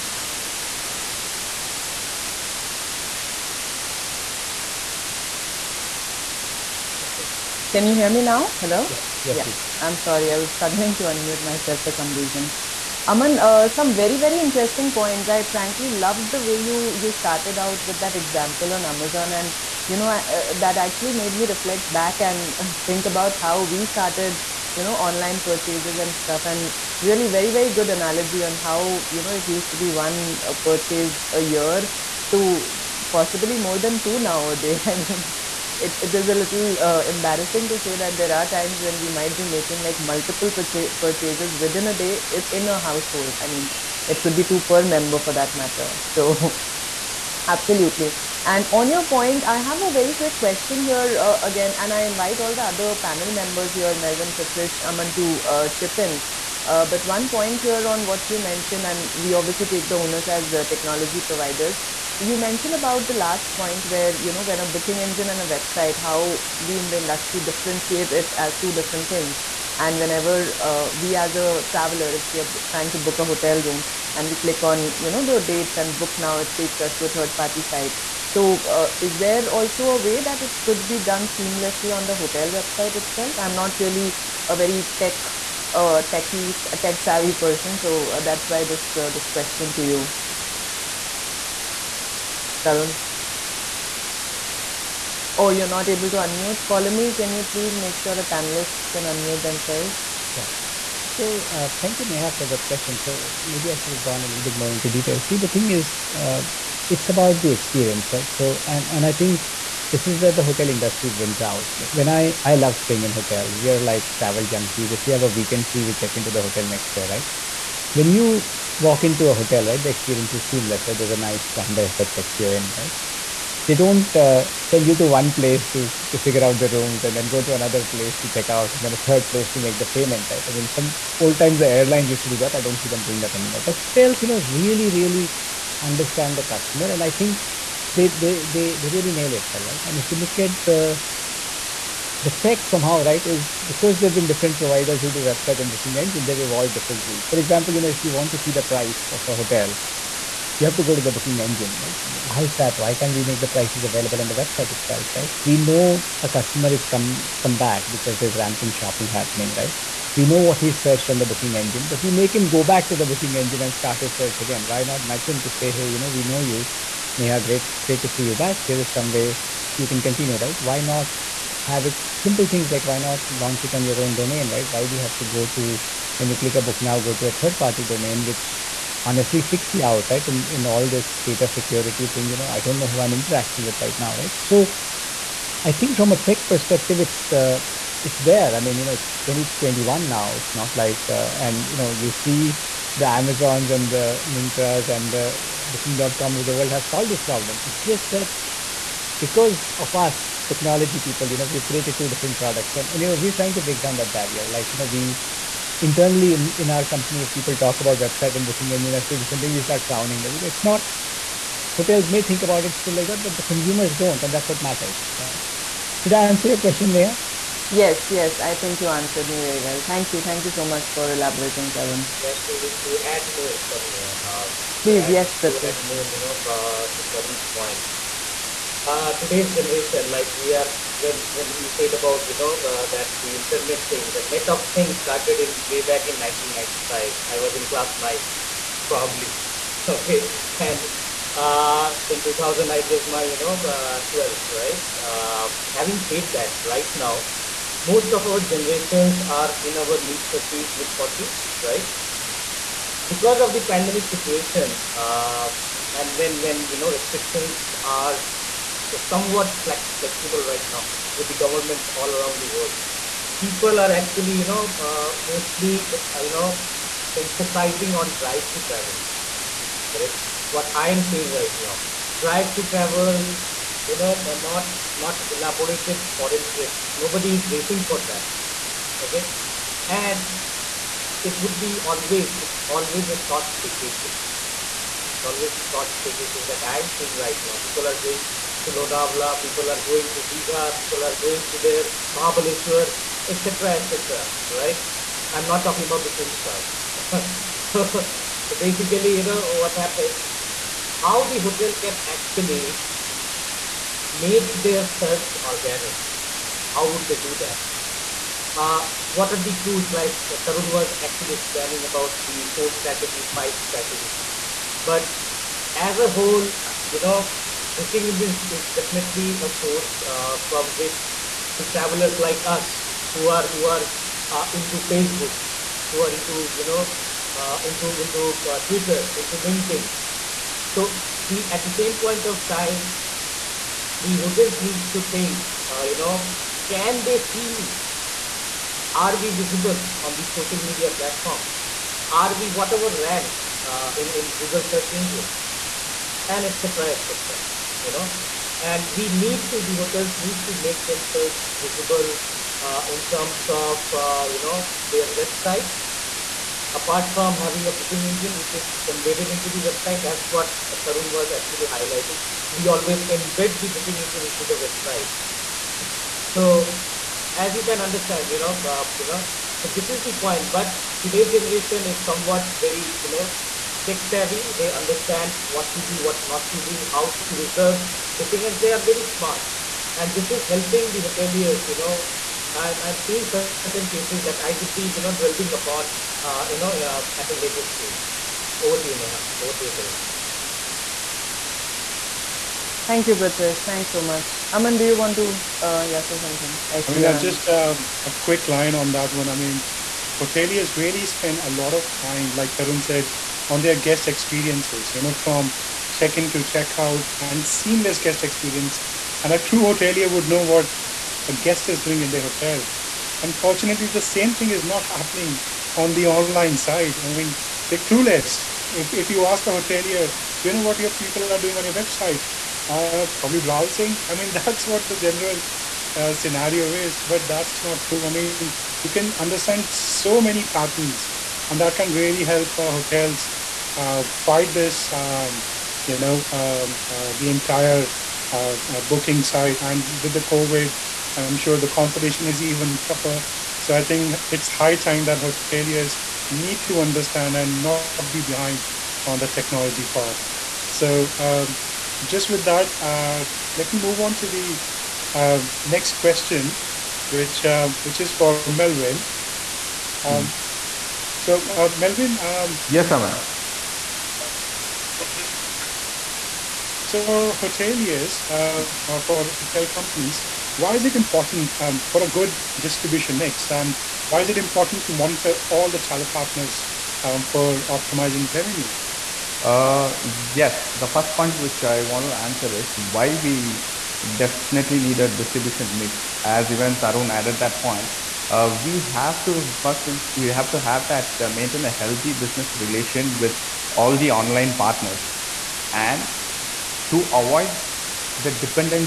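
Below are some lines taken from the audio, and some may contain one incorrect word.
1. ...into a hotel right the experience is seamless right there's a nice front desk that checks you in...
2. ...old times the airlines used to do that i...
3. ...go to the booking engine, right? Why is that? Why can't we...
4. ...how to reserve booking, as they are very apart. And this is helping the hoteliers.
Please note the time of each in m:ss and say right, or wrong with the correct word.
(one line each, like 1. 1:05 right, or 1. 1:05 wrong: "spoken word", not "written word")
1. 1:59 right
2. 2:11 right
3. 2:30 right
4. 6:16 wrong: "smart", not "apart".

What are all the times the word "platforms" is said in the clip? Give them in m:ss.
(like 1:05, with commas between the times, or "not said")
5:40.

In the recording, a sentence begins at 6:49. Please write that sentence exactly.
And a true hotelier would know what a guest is doing in their hotel.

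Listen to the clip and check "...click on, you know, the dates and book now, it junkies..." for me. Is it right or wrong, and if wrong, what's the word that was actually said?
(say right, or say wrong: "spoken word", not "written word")
wrong: "takes", not "junkies".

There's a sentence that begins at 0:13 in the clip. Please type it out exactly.
Aman, uh, some very, very interesting points.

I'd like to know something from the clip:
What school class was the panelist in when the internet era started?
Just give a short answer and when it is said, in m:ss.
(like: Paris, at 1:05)
Class nine, at 3:57.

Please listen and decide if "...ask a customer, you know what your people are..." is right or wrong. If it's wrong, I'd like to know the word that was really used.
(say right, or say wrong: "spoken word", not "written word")
wrong: "hotelier", not "customer".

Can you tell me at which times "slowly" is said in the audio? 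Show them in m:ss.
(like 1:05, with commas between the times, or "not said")
not said.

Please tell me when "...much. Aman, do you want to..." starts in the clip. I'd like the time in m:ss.
6:34.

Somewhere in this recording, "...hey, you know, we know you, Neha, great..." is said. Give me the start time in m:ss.
2:45.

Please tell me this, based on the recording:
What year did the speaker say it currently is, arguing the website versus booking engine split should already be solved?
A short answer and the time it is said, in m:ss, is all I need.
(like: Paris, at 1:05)
2021, at 3:09.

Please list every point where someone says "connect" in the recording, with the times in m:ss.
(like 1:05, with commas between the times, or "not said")
not said.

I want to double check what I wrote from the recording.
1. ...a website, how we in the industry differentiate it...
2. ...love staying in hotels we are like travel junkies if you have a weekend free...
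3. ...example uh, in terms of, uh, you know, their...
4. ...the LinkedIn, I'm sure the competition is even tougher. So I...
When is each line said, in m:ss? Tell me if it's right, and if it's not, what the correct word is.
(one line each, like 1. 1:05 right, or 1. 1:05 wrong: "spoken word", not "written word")
1. 1:05 right
2. 1:52 right
3. 5:51 wrong: "visible", not "example"
4. 7:20 wrong: "COVID", not "LinkedIn".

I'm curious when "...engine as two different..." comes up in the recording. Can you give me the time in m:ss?
3:28.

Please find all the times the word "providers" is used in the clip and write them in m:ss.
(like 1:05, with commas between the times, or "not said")
1:01, 2:24.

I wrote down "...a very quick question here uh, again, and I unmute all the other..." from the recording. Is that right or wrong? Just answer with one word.
wrong.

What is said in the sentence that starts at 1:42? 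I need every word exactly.
So maybe I should have gone a little bit more into detail.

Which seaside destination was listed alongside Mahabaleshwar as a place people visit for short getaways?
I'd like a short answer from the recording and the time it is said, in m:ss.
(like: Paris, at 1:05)
Digha, at 4:50.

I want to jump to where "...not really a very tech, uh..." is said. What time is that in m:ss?
1:23.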